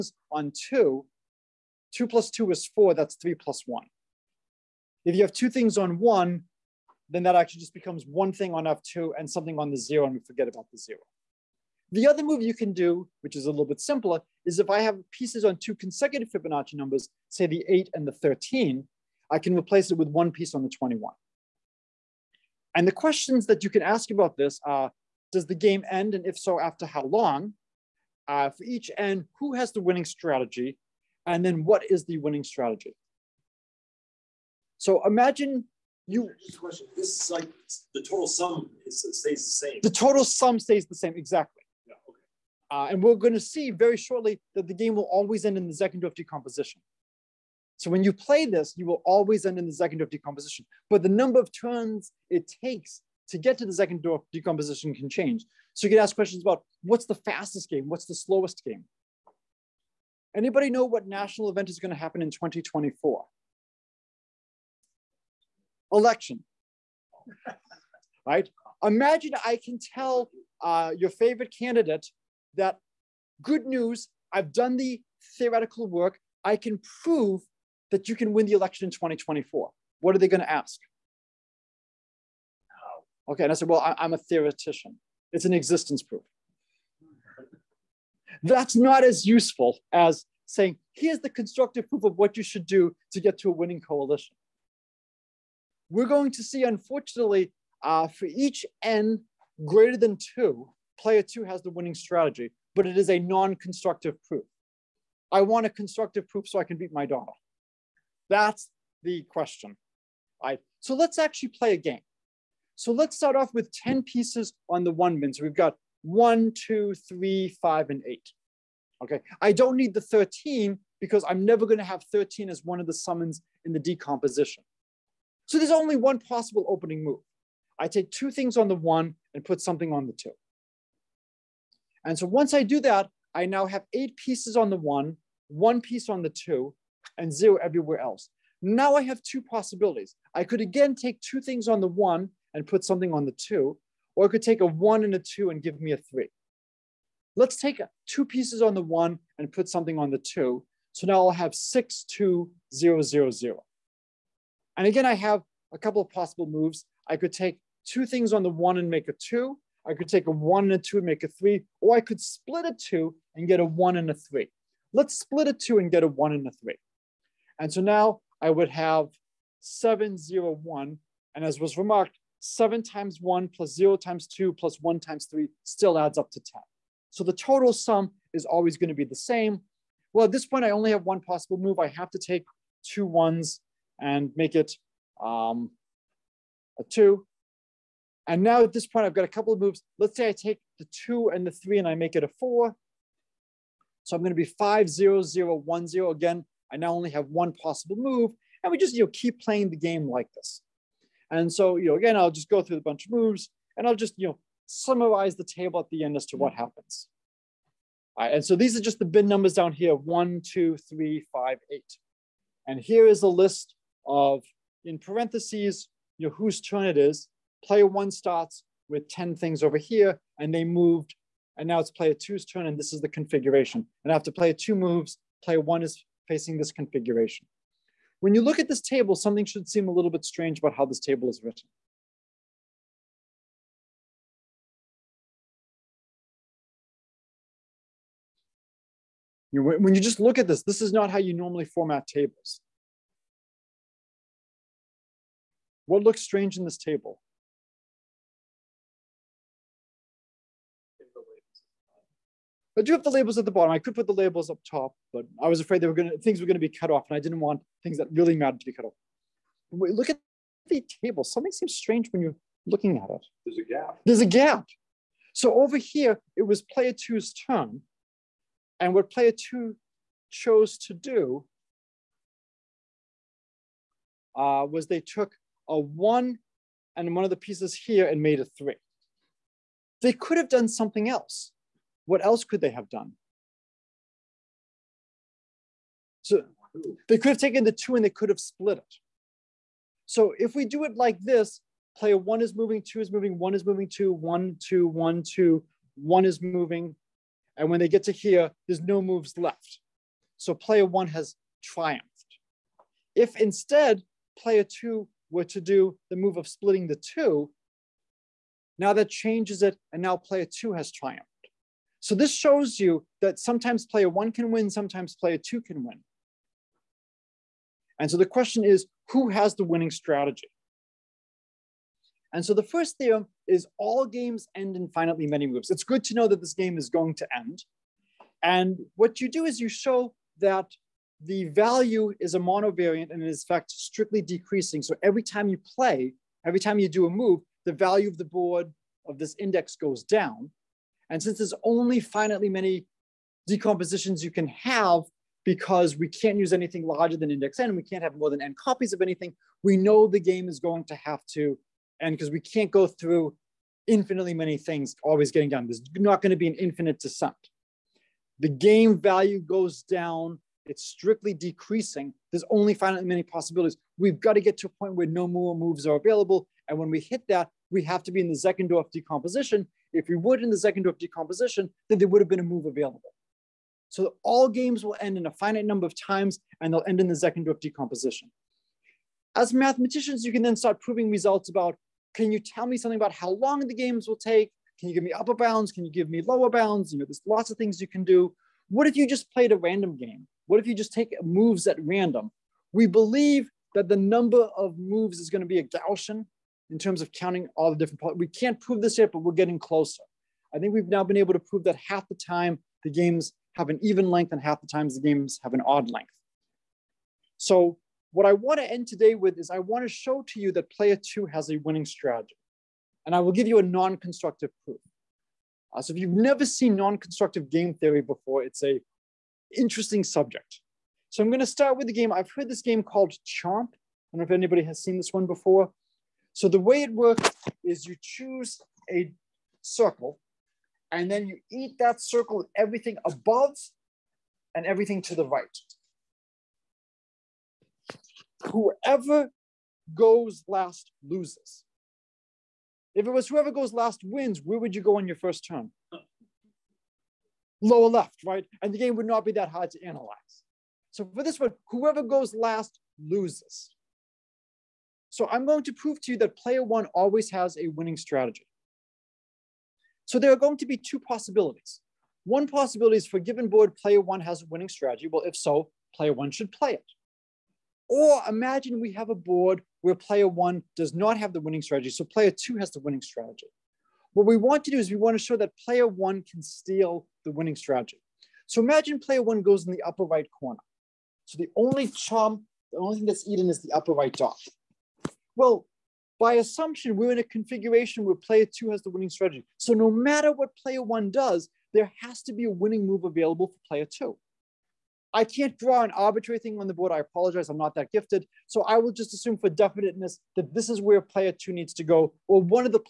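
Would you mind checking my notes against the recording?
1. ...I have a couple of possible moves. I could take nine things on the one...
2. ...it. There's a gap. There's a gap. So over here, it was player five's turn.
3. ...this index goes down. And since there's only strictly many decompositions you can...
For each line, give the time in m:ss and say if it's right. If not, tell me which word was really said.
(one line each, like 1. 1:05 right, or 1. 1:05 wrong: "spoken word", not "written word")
1. 2:35 wrong: "two", not "nine"
2. 4:23 wrong: "two", not "five"
3. 5:39 wrong: "finitely", not "strictly".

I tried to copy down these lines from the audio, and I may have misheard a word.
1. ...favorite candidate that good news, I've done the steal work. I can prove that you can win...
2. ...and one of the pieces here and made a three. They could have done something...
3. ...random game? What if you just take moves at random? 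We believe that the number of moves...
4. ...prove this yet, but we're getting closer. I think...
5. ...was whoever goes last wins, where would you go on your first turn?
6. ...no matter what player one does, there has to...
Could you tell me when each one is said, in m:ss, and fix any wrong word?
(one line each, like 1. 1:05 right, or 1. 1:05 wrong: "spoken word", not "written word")
1. 1:11 wrong: "theoretical", not "steal"
2. 4:36 right
3. 6:29 right
4. 6:38 right
5. 7:23 right
6. 8:09 right.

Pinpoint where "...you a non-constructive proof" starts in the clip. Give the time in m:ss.
6:53.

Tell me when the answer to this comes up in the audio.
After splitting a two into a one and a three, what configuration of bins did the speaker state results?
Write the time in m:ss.
2:49.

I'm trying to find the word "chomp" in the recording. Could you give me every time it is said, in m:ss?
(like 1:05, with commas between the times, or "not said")
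7:03, 8:01.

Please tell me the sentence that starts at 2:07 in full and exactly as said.
I take two things on the one and put something on the two.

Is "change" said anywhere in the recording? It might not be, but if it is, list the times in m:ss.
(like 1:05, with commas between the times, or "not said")
0:55, 5:09.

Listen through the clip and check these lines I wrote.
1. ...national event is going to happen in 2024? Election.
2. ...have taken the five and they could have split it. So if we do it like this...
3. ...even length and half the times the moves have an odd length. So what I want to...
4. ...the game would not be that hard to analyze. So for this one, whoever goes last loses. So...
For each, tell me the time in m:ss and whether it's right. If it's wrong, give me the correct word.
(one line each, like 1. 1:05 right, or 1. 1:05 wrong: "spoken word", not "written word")
1. 1:01 right
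2. 4:47 wrong: "two", not "five"
3. 6:43 wrong: "games", not "moves"
4. 7:28 right.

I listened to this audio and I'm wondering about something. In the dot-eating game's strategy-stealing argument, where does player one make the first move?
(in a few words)
Upper right corner.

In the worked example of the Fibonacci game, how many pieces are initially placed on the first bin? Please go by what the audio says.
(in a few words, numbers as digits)
10.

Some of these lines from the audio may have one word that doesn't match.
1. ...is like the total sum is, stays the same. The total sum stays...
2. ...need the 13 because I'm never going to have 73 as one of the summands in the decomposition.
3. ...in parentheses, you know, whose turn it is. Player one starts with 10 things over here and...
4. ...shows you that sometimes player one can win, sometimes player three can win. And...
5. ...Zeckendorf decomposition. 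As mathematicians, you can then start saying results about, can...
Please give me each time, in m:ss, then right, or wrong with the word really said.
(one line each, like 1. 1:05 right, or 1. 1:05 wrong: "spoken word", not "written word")
1. 0:37 right
2. 1:59 wrong: "13", not "73"
3. 3:34 right
4. 5:12 wrong: "two", not "three"
5. 6:17 wrong: "proving", not "saying".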